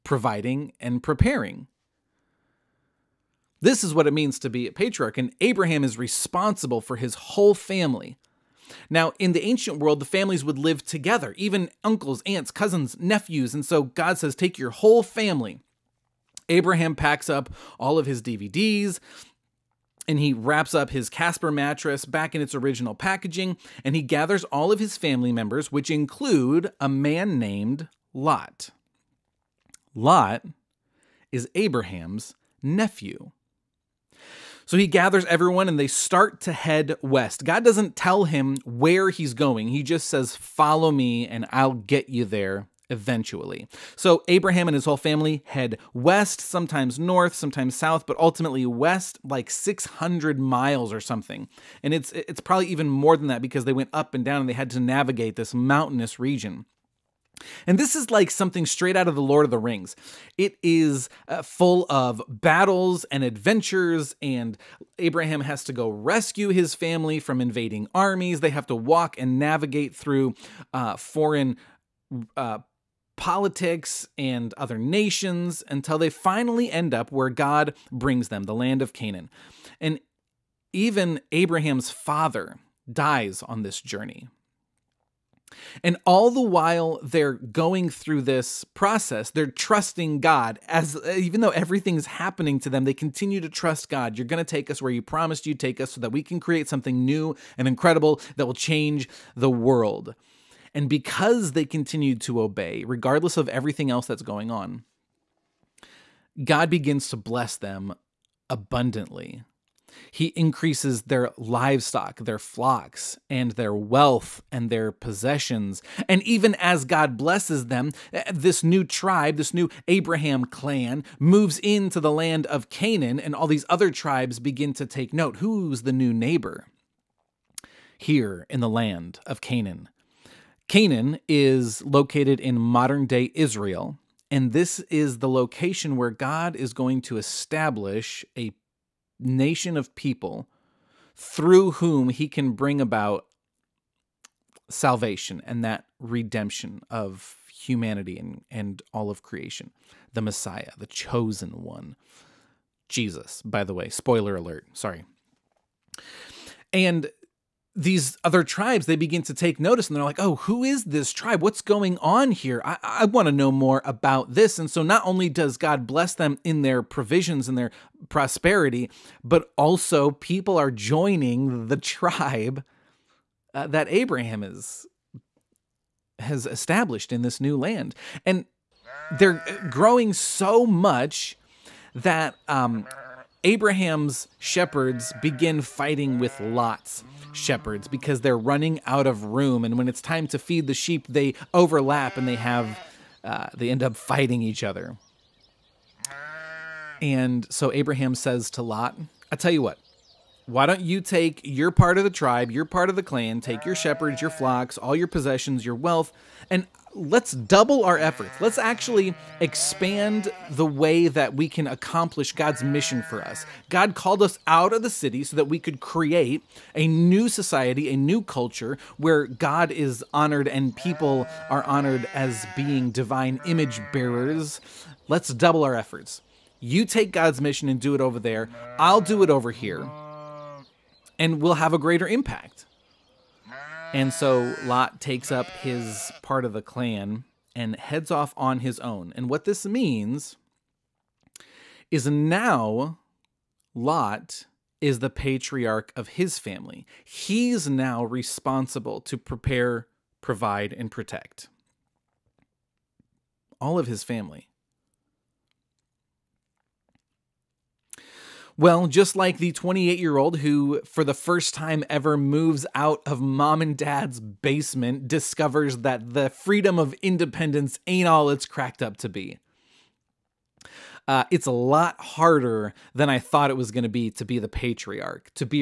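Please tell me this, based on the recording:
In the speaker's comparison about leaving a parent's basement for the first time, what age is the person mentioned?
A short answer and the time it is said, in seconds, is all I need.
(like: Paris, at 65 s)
28, at 259 s.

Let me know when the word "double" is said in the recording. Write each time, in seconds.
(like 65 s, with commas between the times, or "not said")
207 s, 225 s.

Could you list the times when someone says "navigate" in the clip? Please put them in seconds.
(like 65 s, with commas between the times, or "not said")
54 s, 69 s.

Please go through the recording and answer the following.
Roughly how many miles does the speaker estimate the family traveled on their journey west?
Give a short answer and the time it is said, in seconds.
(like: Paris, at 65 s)
600, at 49 s.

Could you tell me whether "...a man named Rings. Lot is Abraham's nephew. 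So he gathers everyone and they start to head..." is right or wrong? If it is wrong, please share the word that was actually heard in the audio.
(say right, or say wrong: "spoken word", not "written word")
wrong: "Lot", not "Rings".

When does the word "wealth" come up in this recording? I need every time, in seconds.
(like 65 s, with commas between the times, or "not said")
113 s, 205 s.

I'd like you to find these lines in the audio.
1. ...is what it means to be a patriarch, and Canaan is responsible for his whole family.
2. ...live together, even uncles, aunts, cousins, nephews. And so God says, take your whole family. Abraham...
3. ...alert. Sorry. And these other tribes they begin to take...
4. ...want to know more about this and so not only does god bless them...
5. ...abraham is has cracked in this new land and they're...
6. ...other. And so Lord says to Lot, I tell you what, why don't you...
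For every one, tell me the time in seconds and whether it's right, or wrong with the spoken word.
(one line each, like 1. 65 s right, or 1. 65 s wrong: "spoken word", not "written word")
1. 3 s wrong: "Abraham", not "Canaan"
2. 10 s right
3. 154 s right
4. 163 s right
5. 173 s wrong: "established", not "cracked"
6. 194 s wrong: "Abraham", not "Lord".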